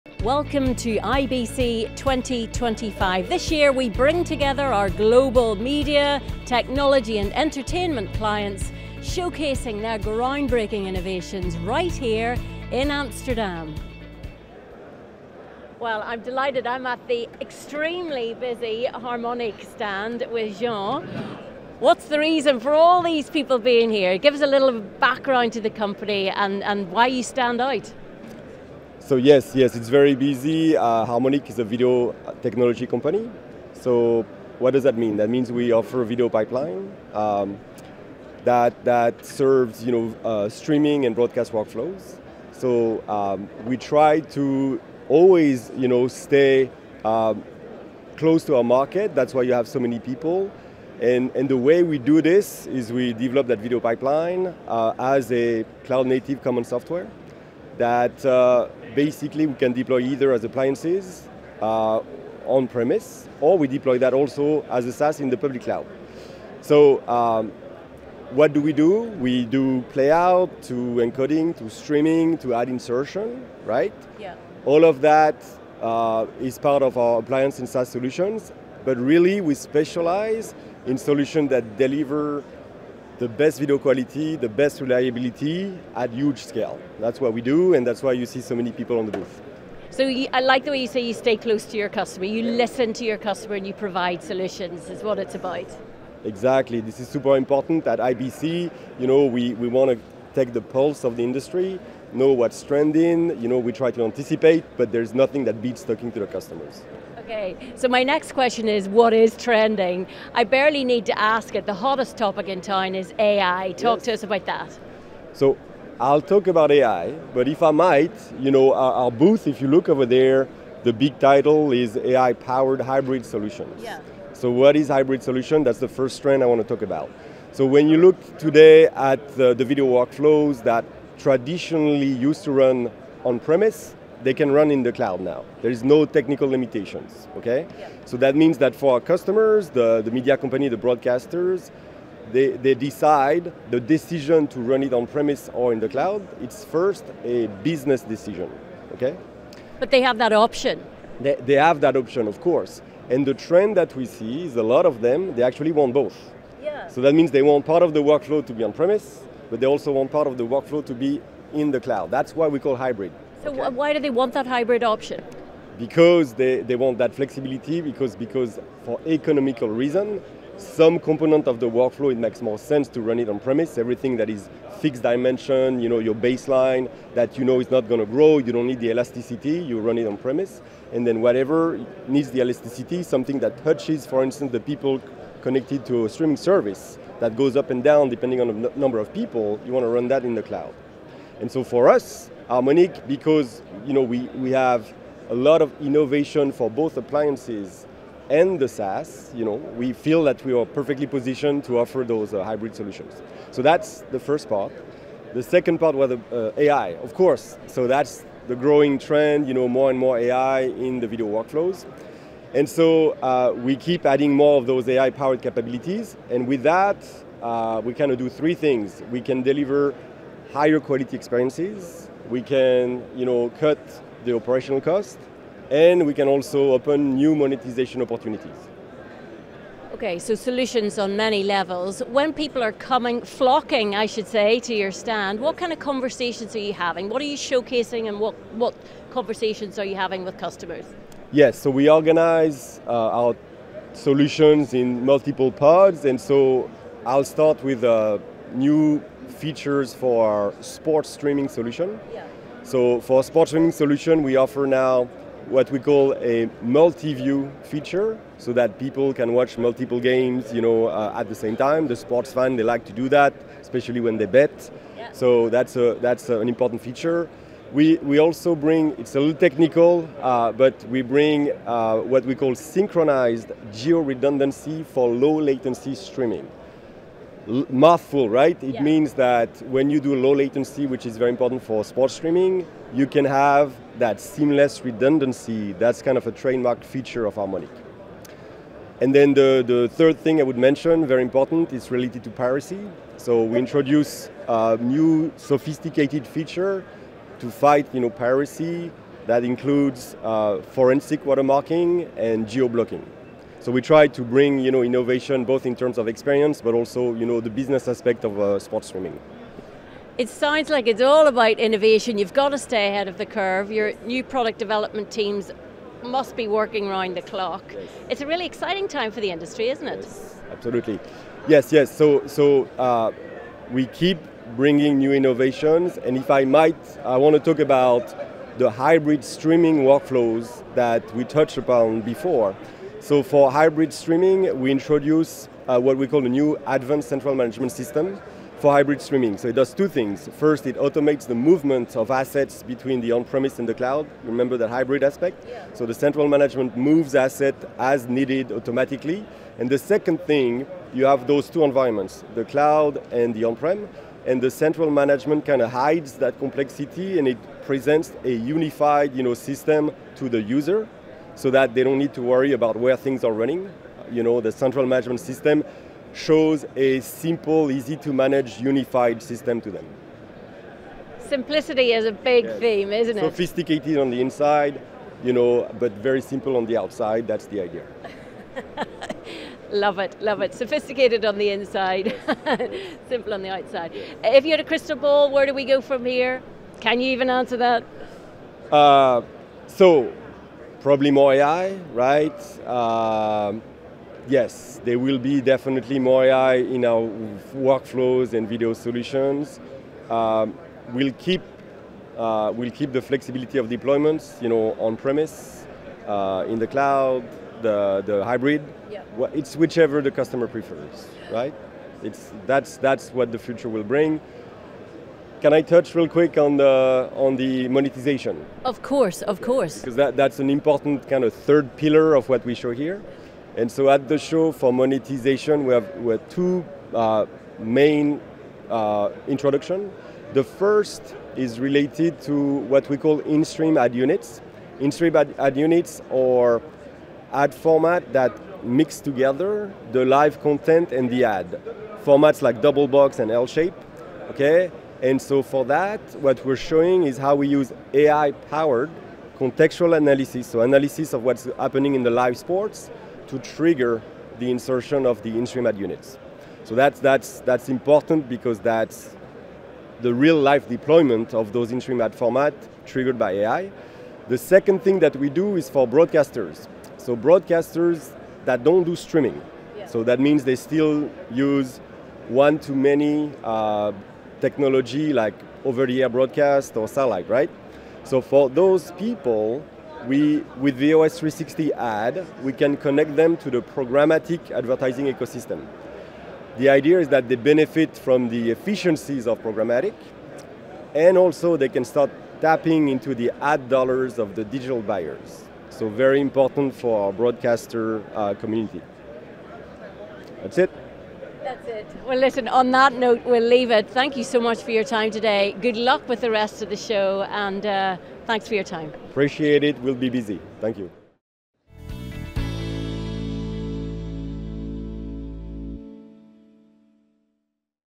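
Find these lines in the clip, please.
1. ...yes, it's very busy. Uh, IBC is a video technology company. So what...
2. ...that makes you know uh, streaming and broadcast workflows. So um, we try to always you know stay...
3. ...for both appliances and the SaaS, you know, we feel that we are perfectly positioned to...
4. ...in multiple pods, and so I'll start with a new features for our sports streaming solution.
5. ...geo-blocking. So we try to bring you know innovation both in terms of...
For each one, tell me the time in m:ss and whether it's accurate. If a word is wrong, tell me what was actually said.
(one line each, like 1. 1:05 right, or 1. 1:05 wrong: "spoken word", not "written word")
1. 0:29 wrong: "Harmonic", not "IBC"
2. 0:38 wrong: "serves", not "makes"
3. 3:16 right
4. 4:04 right
5. 5:02 right.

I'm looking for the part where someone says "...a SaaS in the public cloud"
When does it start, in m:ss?
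1:04.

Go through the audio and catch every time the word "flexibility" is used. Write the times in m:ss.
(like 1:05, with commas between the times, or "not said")
2:47, 6:43.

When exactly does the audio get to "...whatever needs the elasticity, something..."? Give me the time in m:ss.
3:01.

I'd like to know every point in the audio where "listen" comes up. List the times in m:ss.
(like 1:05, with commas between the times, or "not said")
1:32, 8:22.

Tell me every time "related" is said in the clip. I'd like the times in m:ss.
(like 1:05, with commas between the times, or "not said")
4:51, 7:11.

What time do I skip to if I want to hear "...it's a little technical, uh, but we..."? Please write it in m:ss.
4:28.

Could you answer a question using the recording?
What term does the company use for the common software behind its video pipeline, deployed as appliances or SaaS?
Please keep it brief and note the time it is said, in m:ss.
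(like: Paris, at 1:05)
Cloud native, at 0:55.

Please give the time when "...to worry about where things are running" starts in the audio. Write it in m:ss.
6:02.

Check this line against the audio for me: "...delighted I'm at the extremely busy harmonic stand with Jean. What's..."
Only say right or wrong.
right.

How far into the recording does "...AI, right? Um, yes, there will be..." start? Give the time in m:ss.
6:31.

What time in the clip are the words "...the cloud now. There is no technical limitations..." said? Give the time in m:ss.
2:14.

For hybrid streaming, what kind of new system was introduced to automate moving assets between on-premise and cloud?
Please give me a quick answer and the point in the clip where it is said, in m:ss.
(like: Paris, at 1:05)
Advanced central management system, at 5:36.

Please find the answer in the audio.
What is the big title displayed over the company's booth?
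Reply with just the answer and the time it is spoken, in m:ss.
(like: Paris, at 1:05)
AI powered hybrid solutions, at 2:01.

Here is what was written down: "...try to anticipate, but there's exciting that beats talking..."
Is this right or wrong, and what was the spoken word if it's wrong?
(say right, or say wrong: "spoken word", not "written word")
wrong: "nothing", not "exciting".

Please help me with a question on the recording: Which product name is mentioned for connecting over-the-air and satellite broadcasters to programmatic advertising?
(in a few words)
VOS360.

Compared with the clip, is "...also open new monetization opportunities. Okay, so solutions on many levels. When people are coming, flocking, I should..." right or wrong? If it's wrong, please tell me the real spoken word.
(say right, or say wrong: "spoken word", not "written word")
right.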